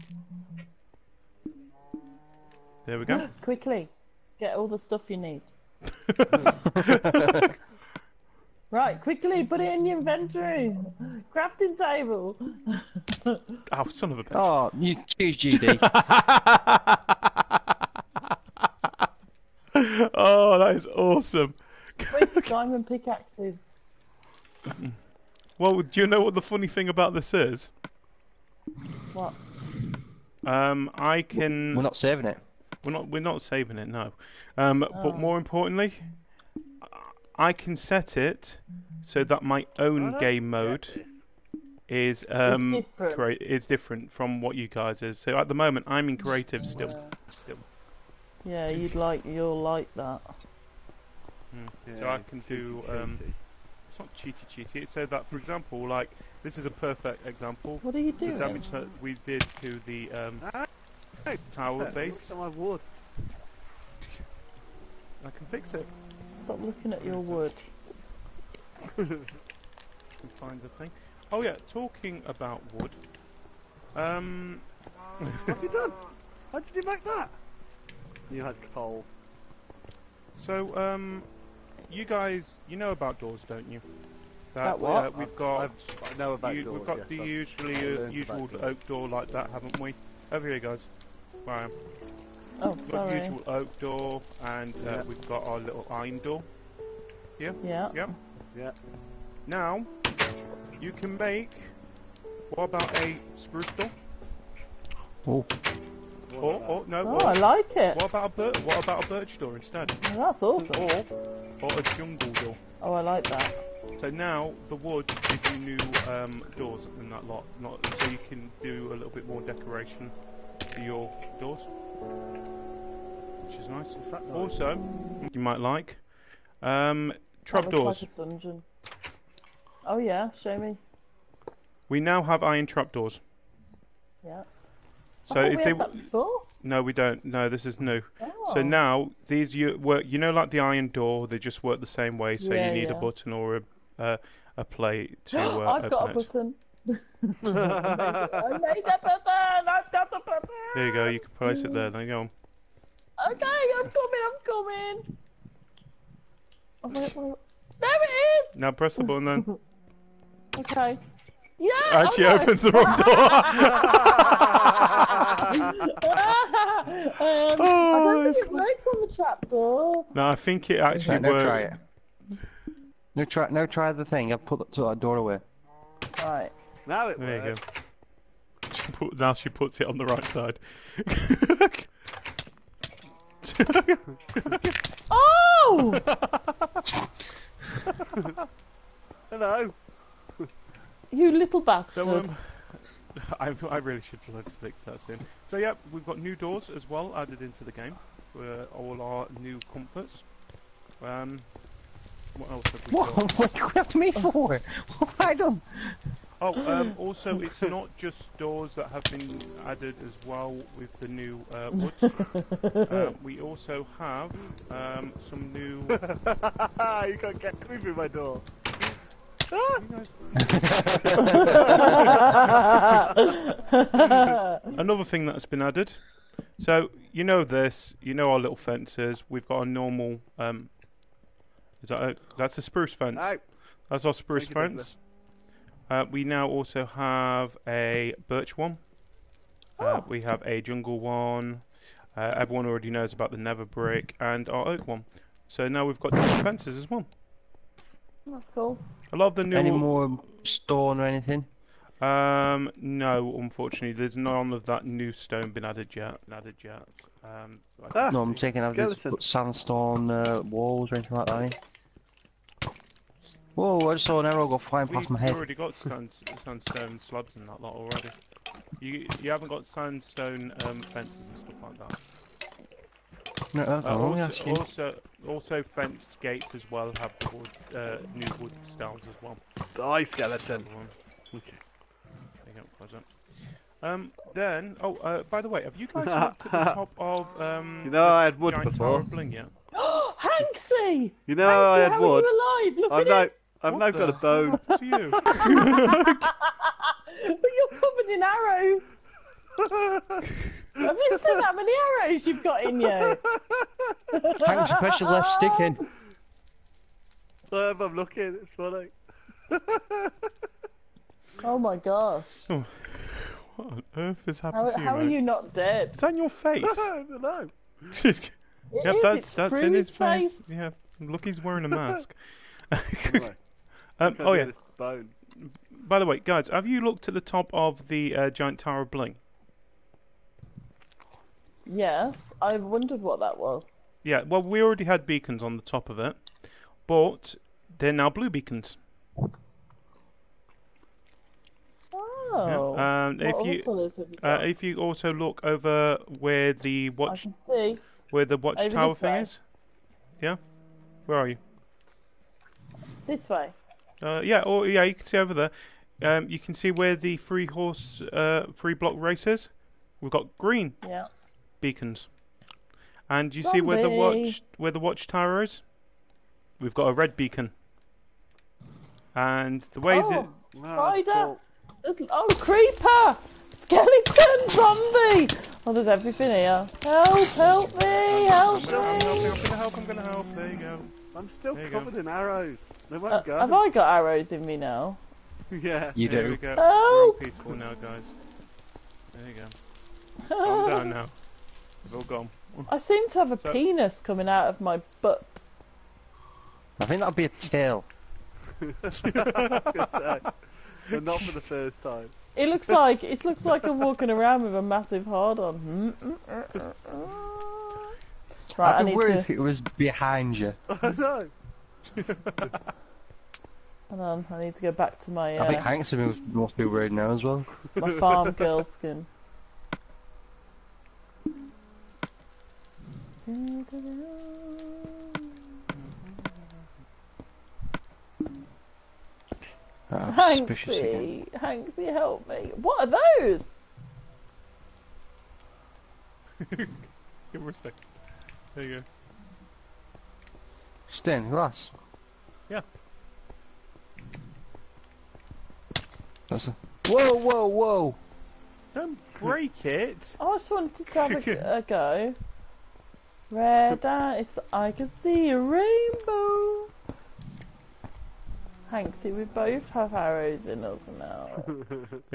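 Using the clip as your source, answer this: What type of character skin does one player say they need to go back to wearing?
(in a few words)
Farm girl.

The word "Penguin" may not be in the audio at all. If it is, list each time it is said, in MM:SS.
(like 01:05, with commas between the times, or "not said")
not said.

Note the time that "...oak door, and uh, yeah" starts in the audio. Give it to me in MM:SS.
01:33.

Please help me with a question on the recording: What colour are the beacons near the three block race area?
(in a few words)
Green.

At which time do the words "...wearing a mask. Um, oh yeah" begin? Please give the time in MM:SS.
05:21.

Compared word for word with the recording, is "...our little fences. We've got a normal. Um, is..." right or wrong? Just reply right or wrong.
right.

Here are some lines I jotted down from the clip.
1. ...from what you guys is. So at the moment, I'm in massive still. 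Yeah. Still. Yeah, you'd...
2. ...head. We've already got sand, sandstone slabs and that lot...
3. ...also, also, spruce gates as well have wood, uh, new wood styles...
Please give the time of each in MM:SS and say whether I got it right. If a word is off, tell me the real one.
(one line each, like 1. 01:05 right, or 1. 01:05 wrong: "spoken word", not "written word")
1. 00:44 wrong: "creative", not "massive"
2. 04:25 right
3. 04:34 wrong: "fence", not "spruce".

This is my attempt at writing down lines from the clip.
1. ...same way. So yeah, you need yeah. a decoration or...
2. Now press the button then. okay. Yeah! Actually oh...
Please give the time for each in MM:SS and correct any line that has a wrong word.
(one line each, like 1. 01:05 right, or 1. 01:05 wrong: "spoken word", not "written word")
1. 02:21 wrong: "button", not "decoration"
2. 02:38 right.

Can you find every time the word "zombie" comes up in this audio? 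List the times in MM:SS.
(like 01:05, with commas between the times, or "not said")
06:03, 06:14.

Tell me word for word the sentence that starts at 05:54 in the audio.
Uh, yeah, or yeah, you can see over there.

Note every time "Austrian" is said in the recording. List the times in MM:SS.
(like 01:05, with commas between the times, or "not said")
not said.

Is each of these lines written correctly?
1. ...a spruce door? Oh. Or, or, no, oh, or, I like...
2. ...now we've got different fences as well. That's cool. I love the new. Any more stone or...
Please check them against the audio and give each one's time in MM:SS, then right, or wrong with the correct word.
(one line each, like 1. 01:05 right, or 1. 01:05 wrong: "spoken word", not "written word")
1. 01:42 right
2. 04:05 right.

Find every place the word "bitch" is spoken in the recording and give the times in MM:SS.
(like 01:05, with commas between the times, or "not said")
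00:14.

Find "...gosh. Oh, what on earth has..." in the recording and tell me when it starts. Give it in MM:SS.
05:11.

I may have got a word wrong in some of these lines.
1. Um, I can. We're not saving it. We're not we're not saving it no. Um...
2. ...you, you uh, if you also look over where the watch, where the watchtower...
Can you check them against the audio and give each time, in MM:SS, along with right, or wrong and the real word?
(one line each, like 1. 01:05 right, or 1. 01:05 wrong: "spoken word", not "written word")
1. 00:30 right
2. 05:43 right.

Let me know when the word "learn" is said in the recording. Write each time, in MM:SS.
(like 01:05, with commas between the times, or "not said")
03:14.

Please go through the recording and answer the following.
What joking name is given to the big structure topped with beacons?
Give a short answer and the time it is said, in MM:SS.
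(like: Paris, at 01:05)
Giant tower of bling, at 05:28.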